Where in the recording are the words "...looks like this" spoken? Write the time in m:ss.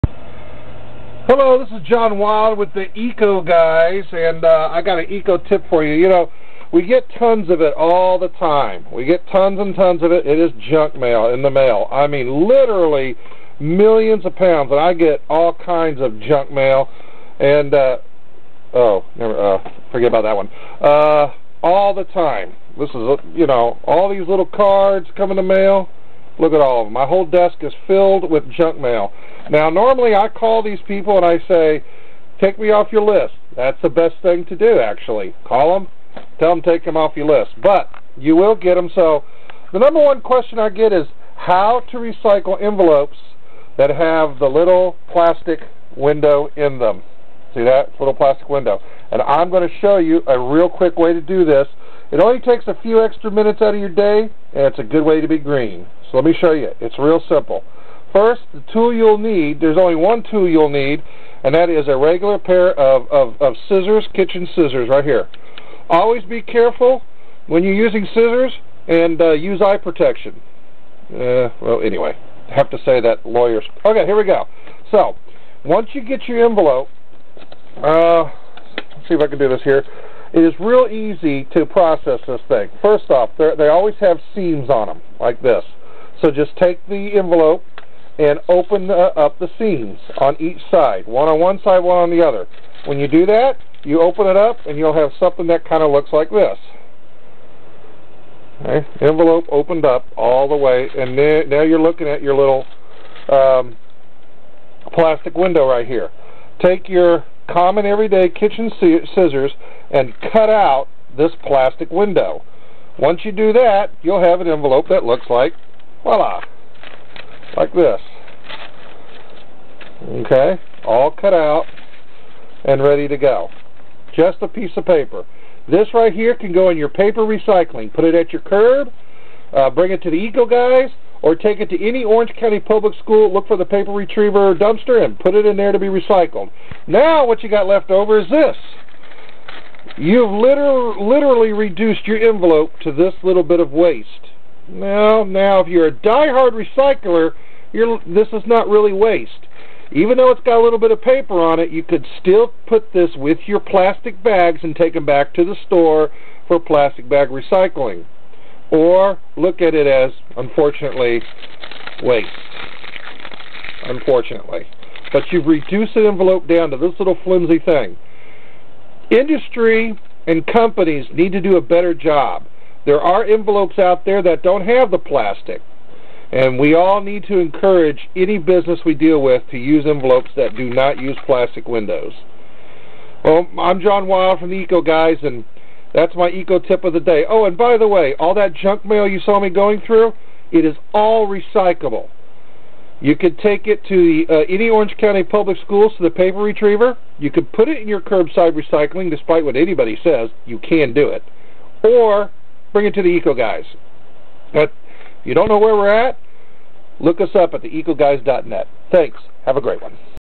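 1:35.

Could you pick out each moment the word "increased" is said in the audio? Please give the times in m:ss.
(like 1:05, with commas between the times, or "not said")
not said.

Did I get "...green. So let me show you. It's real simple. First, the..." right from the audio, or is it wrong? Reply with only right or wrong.
right.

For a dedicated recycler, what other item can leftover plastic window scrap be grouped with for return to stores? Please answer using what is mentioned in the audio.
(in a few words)
plastic bags.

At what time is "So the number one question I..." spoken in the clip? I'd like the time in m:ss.
0:38.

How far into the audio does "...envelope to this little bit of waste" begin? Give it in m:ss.
2:22.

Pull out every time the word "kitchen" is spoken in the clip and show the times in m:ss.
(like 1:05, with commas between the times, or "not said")
1:04, 1:48.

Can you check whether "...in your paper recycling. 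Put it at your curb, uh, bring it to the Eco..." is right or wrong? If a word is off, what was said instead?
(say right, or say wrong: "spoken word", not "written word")
right.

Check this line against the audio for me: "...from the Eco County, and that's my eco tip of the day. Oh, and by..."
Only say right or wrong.
wrong.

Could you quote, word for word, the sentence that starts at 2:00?
Okay, all cut out and ready to go.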